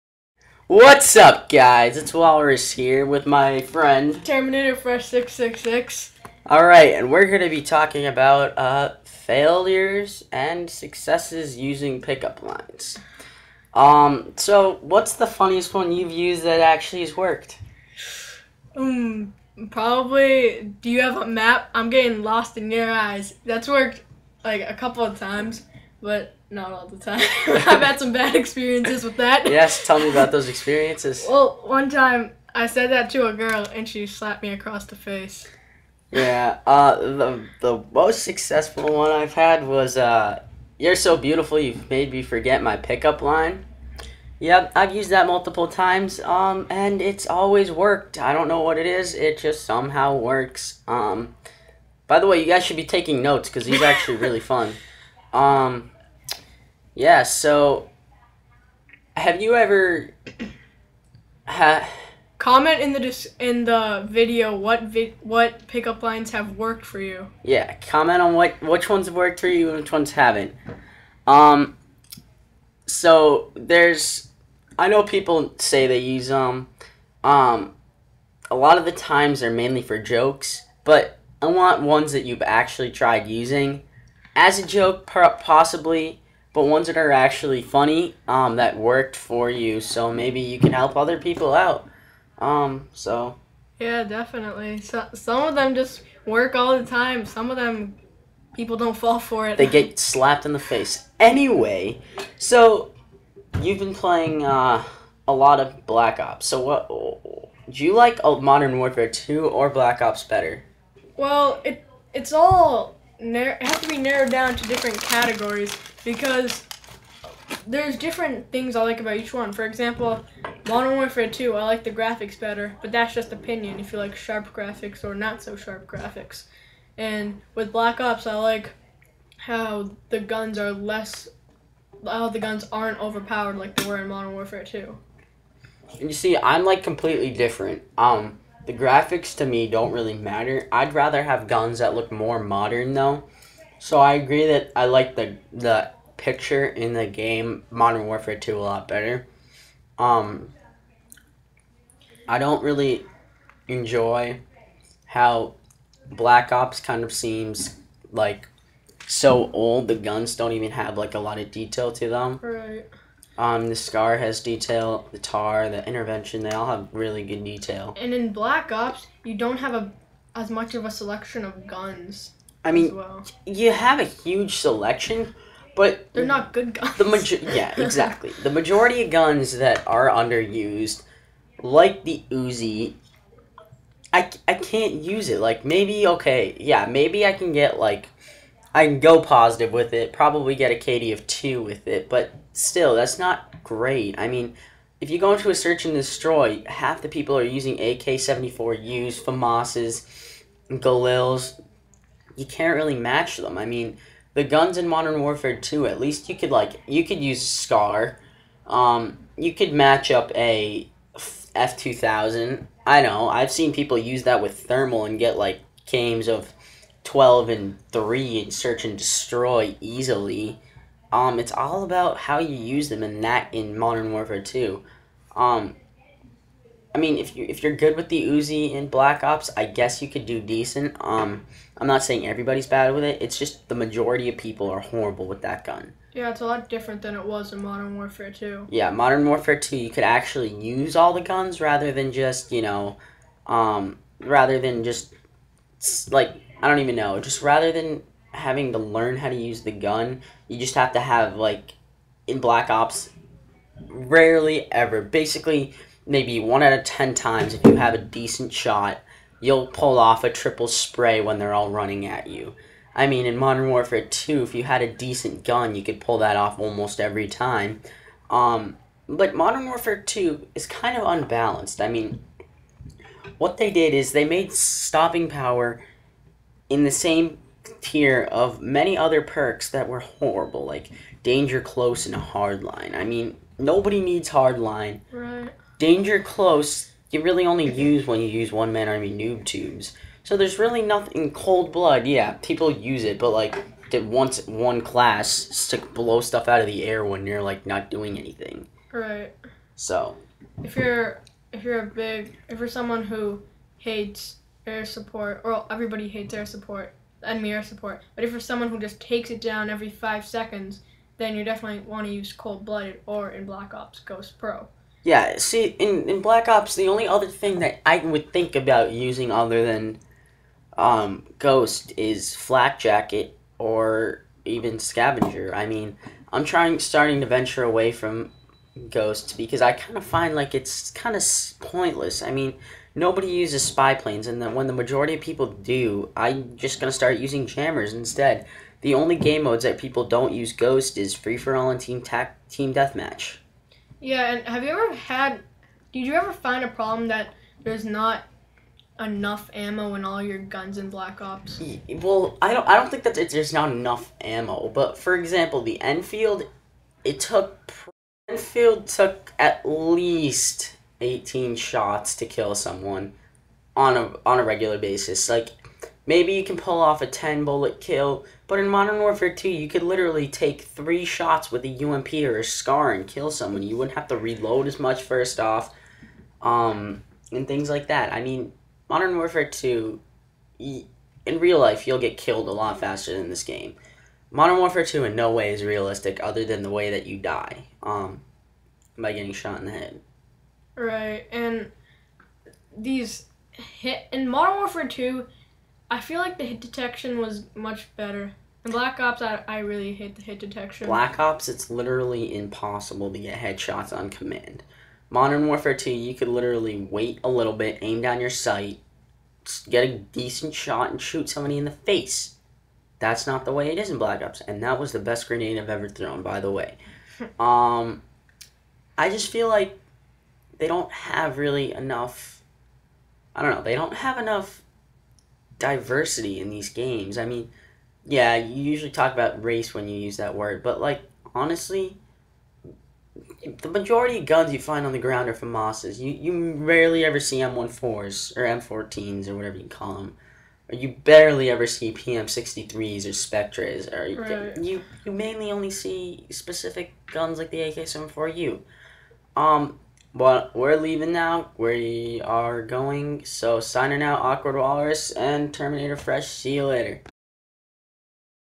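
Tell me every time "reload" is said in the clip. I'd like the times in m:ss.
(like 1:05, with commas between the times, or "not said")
6:14.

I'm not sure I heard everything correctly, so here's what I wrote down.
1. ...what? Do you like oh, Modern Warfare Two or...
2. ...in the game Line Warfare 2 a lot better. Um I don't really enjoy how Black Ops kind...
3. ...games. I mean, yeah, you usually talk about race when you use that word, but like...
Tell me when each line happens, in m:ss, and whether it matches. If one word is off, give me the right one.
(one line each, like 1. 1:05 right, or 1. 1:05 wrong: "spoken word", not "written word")
1. 1:46 right
2. 2:26 wrong: "Modern", not "Line"
3. 7:06 right.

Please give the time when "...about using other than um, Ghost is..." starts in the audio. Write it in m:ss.
5:18.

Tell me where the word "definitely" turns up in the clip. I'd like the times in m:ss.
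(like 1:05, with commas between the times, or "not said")
1:34, 5:11.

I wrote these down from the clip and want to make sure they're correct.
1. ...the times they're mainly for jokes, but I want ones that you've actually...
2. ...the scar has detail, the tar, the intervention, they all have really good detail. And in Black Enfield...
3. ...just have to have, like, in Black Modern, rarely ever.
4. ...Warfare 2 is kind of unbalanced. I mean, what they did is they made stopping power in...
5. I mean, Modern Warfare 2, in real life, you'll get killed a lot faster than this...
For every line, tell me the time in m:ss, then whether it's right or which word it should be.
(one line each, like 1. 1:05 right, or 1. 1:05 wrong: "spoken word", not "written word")
1. 1:18 right
2. 2:43 wrong: "Ops", not "Enfield"
3. 4:10 wrong: "Ops", not "Modern"
4. 4:29 right
5. 6:18 right.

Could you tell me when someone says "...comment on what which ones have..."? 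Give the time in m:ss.
1:07.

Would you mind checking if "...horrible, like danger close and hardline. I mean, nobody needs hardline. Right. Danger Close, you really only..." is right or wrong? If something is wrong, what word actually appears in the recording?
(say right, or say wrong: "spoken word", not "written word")
right.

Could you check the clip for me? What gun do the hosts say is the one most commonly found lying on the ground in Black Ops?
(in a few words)
FAMAS.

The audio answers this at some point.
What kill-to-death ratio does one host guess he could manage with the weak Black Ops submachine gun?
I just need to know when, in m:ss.
3:10.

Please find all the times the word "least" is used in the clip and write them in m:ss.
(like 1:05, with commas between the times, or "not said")
3:25, 5:59.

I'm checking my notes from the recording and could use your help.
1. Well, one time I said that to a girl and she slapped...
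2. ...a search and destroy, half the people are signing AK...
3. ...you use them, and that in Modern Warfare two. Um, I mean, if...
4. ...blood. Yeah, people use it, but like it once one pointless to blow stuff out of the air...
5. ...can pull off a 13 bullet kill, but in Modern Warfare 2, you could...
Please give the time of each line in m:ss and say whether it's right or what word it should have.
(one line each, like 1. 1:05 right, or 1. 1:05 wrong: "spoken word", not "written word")
1. 0:31 right
2. 3:15 wrong: "using", not "signing"
3. 3:42 right
4. 4:51 wrong: "class", not "pointless"
5. 6:06 wrong: "10", not "13".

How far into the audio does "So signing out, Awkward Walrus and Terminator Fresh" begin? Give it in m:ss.
7:33.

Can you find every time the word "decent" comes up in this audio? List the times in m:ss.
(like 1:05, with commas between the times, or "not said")
3:50, 4:17, 4:24, 6:49.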